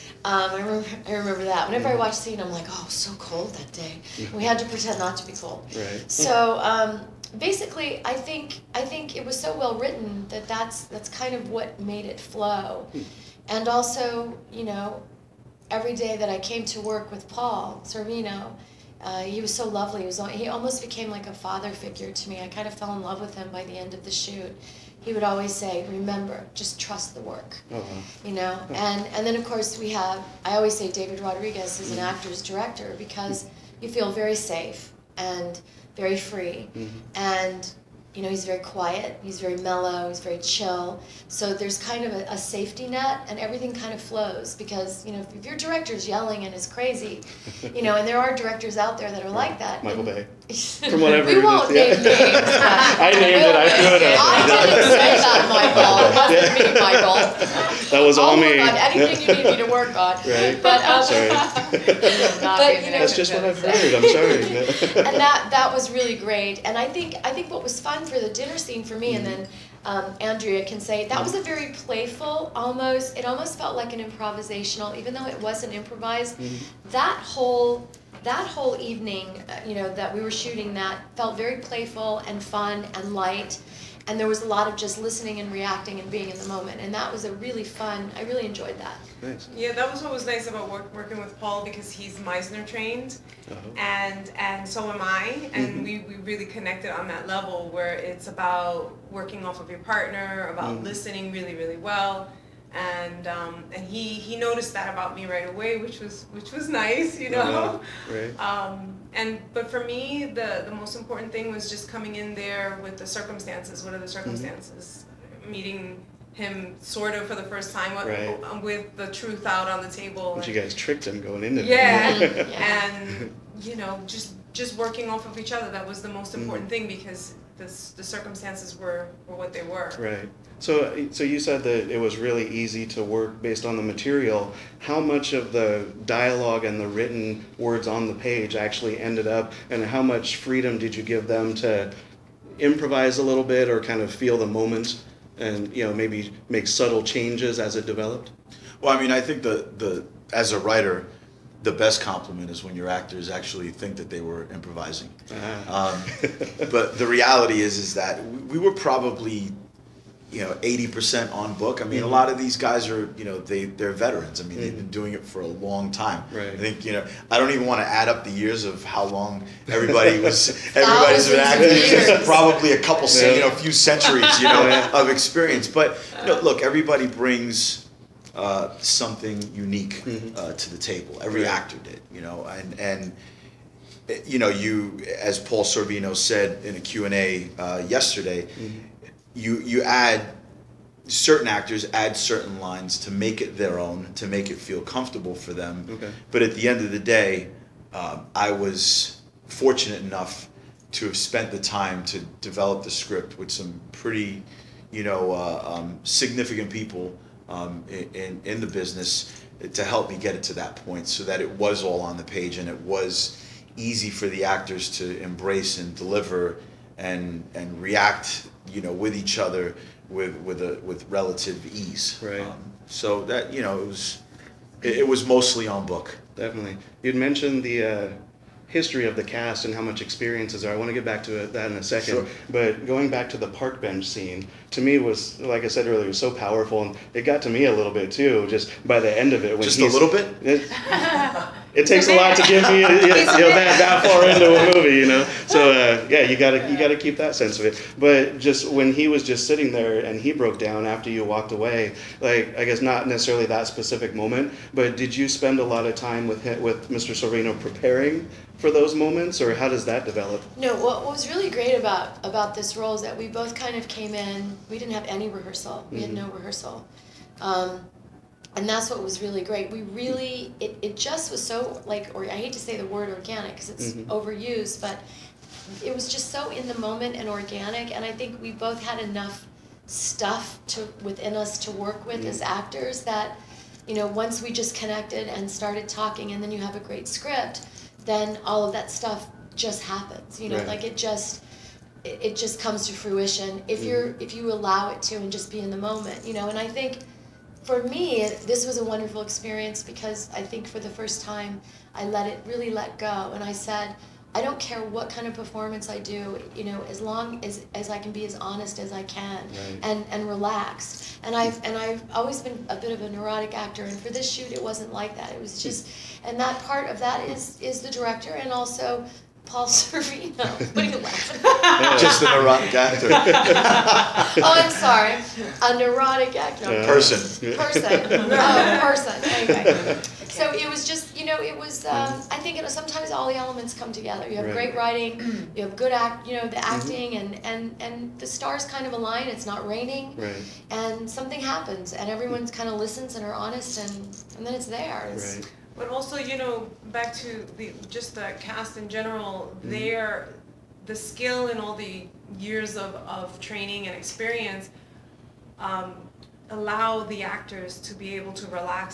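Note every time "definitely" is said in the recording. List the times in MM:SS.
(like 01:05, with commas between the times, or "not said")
03:46.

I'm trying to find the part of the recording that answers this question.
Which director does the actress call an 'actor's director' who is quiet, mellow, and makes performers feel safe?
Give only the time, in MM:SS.
00:30.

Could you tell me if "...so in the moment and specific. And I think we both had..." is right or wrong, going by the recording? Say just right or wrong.
wrong.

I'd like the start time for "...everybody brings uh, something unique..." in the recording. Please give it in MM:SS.
02:56.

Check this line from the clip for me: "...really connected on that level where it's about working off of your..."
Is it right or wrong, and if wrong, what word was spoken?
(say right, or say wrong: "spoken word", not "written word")
right.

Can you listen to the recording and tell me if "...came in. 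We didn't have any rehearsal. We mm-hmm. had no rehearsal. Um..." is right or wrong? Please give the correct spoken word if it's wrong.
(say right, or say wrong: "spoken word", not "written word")
right.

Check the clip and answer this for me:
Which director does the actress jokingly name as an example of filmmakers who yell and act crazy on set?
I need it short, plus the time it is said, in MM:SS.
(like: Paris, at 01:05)
Michael Bay, at 00:49.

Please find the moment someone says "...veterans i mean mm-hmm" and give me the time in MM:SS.
02:43.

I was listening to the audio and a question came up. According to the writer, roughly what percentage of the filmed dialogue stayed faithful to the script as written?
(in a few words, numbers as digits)
80%.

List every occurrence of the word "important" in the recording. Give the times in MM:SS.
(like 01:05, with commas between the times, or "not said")
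01:50, 02:06.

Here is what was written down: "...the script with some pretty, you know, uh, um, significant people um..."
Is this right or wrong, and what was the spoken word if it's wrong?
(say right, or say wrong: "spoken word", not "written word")
right.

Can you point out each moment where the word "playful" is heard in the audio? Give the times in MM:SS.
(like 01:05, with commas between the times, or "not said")
01:11, 01:21.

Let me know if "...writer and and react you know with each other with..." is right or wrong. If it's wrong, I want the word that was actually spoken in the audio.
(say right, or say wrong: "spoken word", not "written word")
wrong: "deliver", not "writer".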